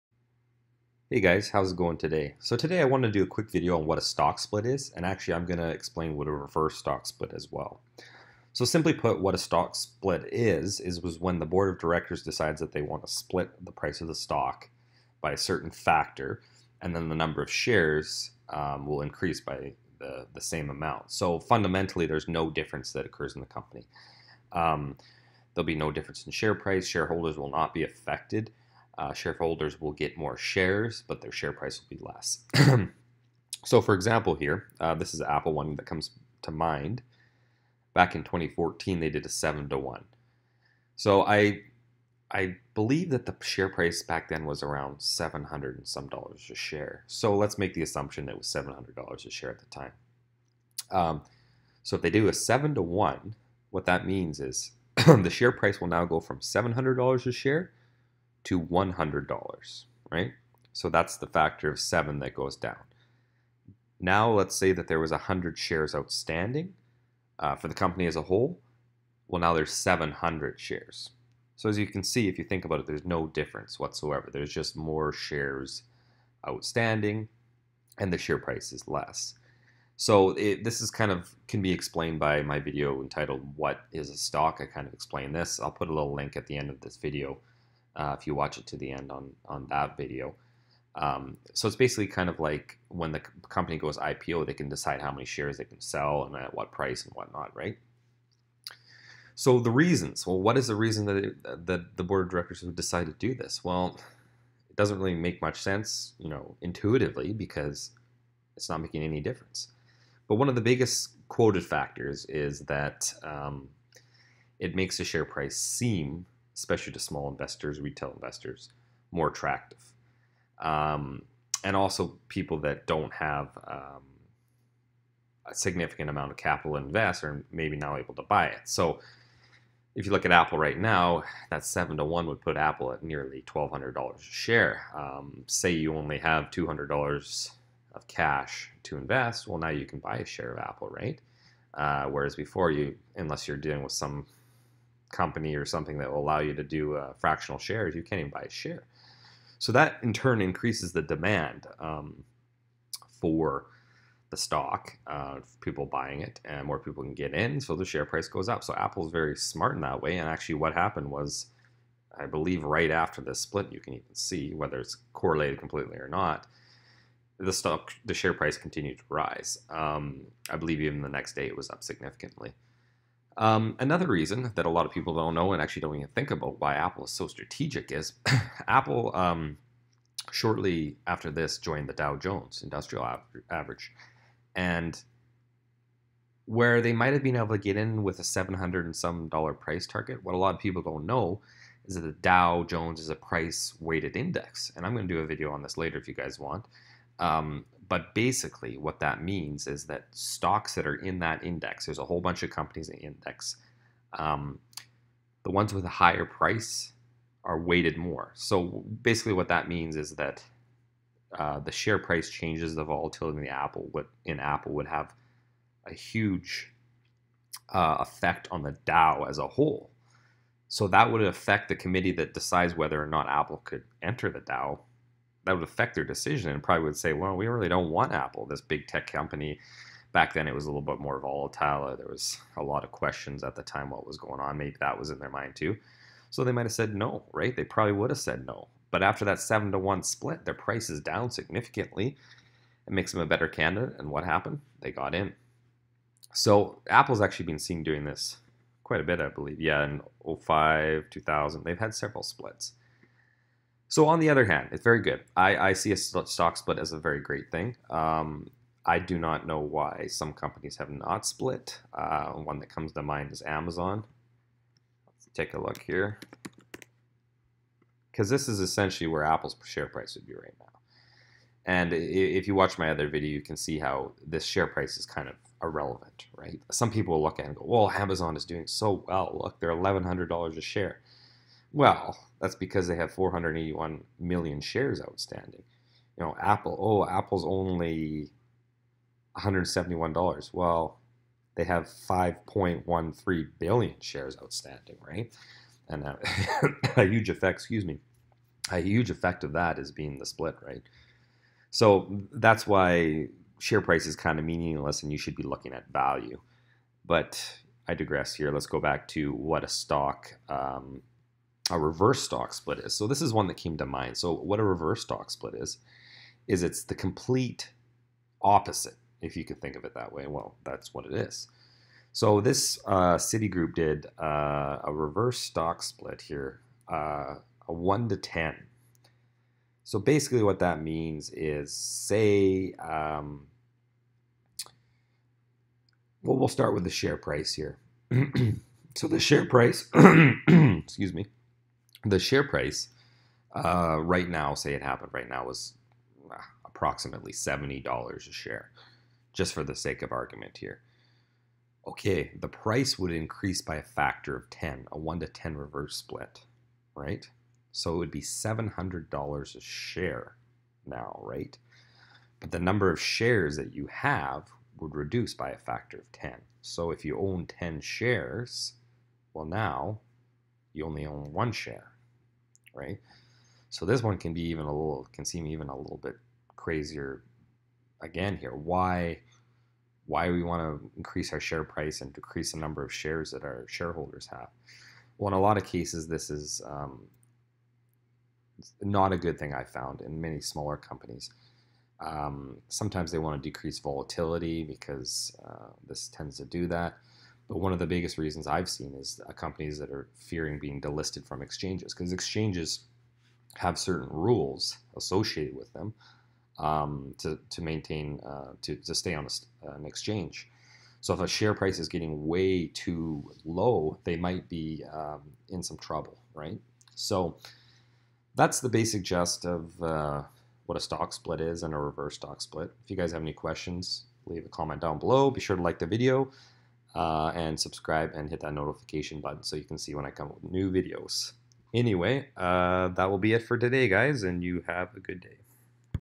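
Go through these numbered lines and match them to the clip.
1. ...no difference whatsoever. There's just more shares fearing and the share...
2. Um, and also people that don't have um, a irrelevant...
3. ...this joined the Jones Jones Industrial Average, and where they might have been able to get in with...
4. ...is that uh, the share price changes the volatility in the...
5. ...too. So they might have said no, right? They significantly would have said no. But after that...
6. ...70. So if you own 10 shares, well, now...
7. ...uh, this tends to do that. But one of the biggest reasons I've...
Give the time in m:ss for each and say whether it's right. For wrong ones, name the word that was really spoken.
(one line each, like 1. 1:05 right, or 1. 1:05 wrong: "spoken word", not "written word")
1. 1:13 wrong: "outstanding", not "fearing"
2. 2:00 wrong: "significant", not "irrelevant"
3. 3:01 wrong: "Dow", not "Jones"
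4. 3:29 right
5. 3:55 wrong: "probably", not "significantly"
6. 6:06 wrong: "10", not "70"
7. 6:35 right.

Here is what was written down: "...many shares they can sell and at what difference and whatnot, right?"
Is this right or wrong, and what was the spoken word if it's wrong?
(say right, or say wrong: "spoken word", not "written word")
wrong: "price", not "difference".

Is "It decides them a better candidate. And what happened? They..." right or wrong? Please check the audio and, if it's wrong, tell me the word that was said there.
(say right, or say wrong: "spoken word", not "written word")
wrong: "makes", not "decides".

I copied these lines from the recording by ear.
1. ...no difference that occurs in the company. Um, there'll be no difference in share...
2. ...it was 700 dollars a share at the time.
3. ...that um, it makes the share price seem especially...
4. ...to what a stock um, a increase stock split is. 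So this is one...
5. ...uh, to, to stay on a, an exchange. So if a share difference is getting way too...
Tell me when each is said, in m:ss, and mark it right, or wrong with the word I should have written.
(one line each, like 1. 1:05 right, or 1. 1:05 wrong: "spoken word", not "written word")
1. 0:22 right
2. 0:48 right
3. 1:52 right
4. 5:09 wrong: "reverse", not "increase"
5. 6:48 wrong: "price", not "difference".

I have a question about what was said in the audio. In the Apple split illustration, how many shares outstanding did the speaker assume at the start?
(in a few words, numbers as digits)
100.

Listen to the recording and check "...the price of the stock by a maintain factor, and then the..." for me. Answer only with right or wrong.
wrong.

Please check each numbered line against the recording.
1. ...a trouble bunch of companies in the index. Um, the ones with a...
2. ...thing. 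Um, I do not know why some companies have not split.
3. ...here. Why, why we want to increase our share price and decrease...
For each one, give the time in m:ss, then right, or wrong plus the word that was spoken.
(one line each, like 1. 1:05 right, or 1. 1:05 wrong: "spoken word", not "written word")
1. 3:21 wrong: "whole", not "trouble"
2. 4:17 right
3. 6:18 right.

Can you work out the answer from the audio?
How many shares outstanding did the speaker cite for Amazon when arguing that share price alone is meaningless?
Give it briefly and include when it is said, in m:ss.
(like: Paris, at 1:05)
481 million, at 4:43.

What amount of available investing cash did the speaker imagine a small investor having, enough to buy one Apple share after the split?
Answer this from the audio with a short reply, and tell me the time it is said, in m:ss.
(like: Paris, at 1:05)
$200, at 2:16.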